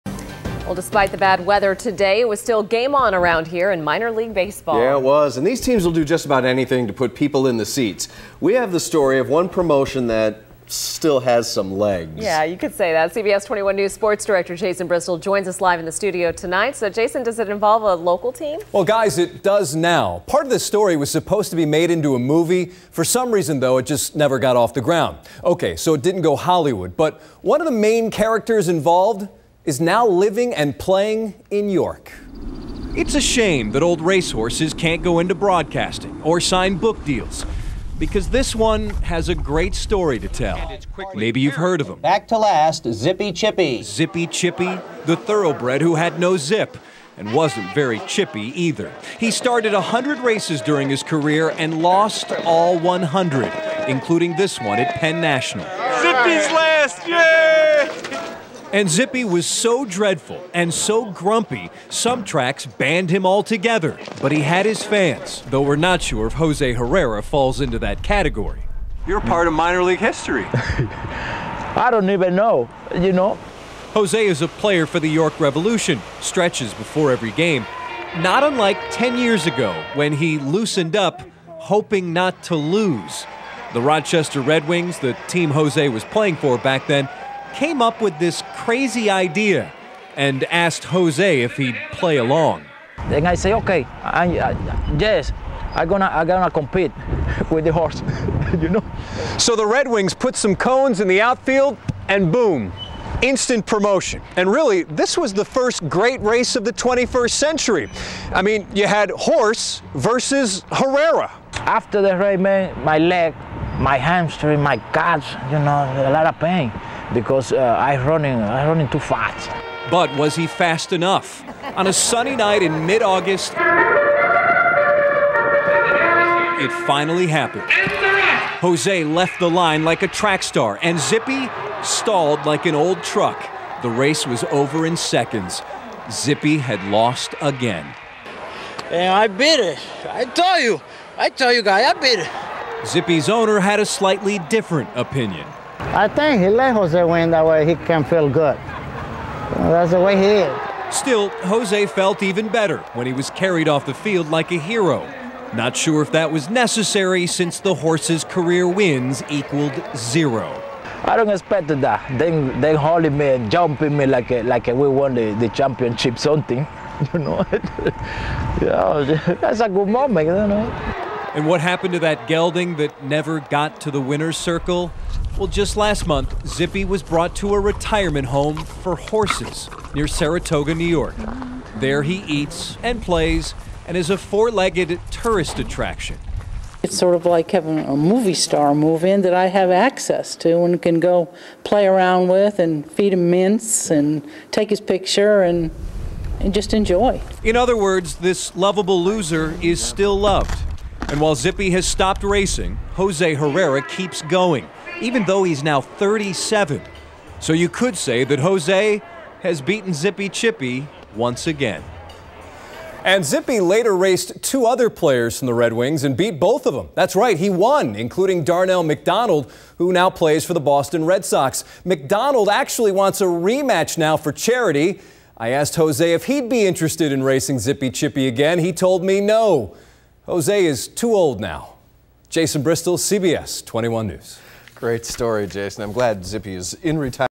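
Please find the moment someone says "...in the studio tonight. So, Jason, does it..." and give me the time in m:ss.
0:15.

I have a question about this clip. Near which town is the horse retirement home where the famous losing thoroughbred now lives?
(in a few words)
Saratoga.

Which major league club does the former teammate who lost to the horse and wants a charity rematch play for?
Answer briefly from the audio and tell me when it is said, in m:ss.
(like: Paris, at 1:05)
Boston Red Sox, at 3:40.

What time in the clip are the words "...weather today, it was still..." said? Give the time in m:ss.
0:01.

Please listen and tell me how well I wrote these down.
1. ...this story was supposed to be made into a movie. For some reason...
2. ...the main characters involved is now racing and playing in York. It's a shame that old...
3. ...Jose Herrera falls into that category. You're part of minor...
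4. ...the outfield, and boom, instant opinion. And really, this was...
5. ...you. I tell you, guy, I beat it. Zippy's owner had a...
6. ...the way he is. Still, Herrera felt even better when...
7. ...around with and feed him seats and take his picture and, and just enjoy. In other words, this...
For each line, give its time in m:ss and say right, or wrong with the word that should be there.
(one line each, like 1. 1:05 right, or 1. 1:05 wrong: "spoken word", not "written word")
1. 0:20 right
2. 0:27 wrong: "living", not "racing"
3. 1:06 right
4. 1:41 wrong: "promotion", not "opinion"
5. 2:20 right
6. 2:29 wrong: "Jose", not "Herrera"
7. 3:11 wrong: "mints", not "seats".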